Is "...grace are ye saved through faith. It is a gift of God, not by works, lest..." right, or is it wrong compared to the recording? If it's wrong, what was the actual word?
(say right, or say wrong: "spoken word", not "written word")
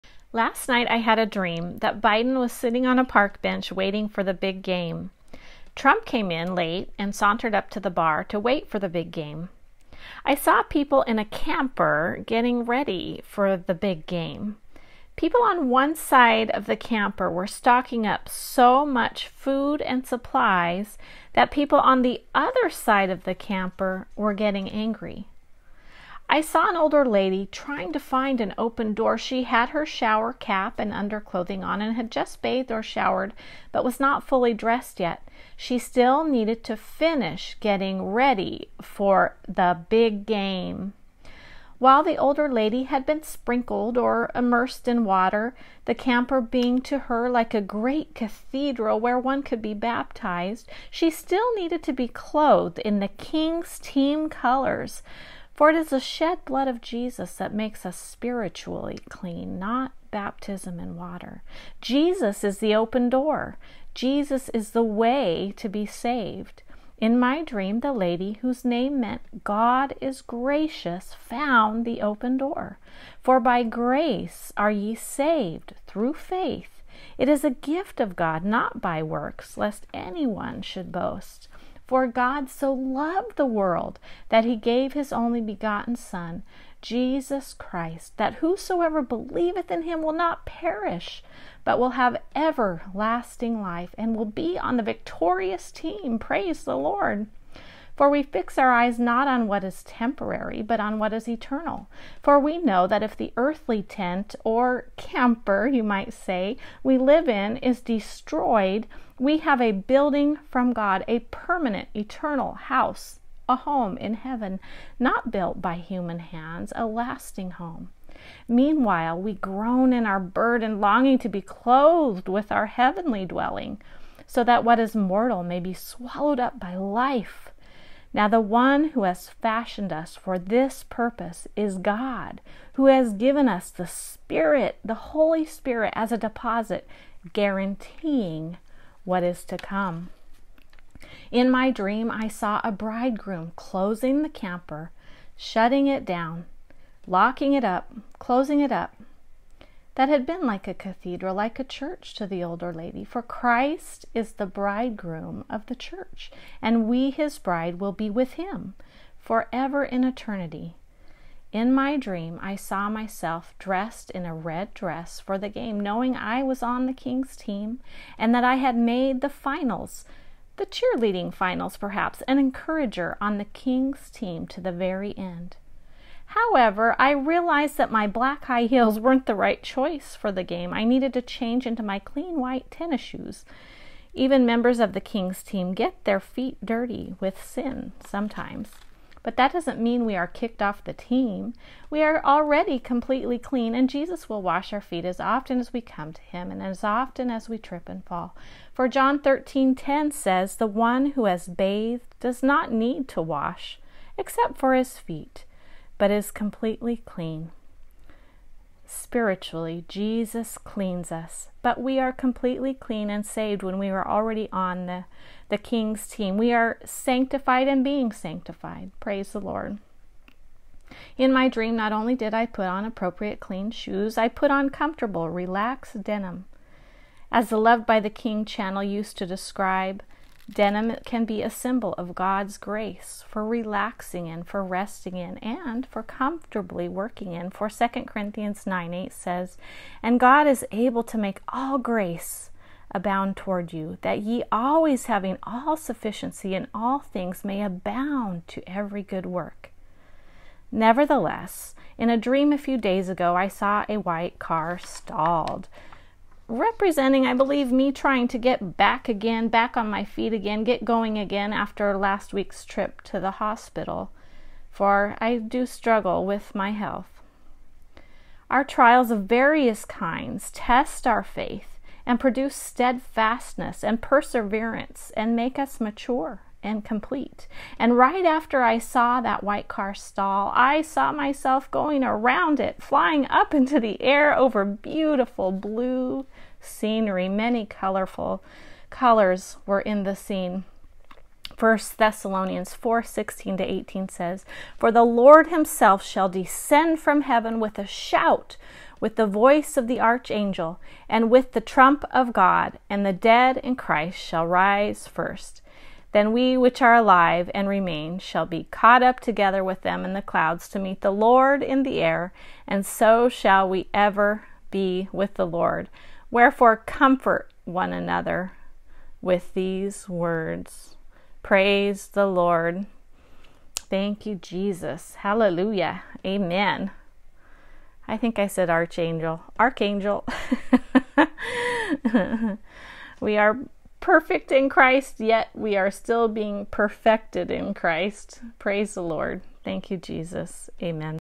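right.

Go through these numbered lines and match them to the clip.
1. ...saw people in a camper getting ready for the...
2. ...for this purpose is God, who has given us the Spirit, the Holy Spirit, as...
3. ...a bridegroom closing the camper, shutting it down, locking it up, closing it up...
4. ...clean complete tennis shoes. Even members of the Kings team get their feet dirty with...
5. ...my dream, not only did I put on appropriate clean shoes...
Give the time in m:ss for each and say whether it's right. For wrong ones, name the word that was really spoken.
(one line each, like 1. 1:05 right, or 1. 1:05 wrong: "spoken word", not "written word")
1. 0:10 right
2. 2:10 right
3. 2:22 right
4. 3:01 wrong: "white", not "complete"
5. 3:41 right.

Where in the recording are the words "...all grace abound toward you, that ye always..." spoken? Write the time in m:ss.
4:01.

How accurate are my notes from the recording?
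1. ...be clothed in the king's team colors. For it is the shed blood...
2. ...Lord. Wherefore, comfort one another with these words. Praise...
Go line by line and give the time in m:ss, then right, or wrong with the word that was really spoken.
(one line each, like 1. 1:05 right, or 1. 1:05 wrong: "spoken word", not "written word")
1. 0:51 right
2. 5:15 right.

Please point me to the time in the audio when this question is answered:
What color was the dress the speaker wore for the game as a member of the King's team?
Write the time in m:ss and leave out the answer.
2:44.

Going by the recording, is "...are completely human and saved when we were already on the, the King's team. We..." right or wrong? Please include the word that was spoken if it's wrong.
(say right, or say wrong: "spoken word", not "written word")
wrong: "clean", not "human".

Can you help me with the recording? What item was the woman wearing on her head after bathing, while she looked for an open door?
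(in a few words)
Shower cap.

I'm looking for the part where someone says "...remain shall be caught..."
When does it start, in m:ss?
5:07.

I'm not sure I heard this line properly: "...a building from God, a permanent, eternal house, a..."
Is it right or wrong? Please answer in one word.
right.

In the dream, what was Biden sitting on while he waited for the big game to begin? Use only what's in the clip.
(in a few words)
Park bench.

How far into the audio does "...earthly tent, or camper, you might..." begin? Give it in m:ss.
1:43.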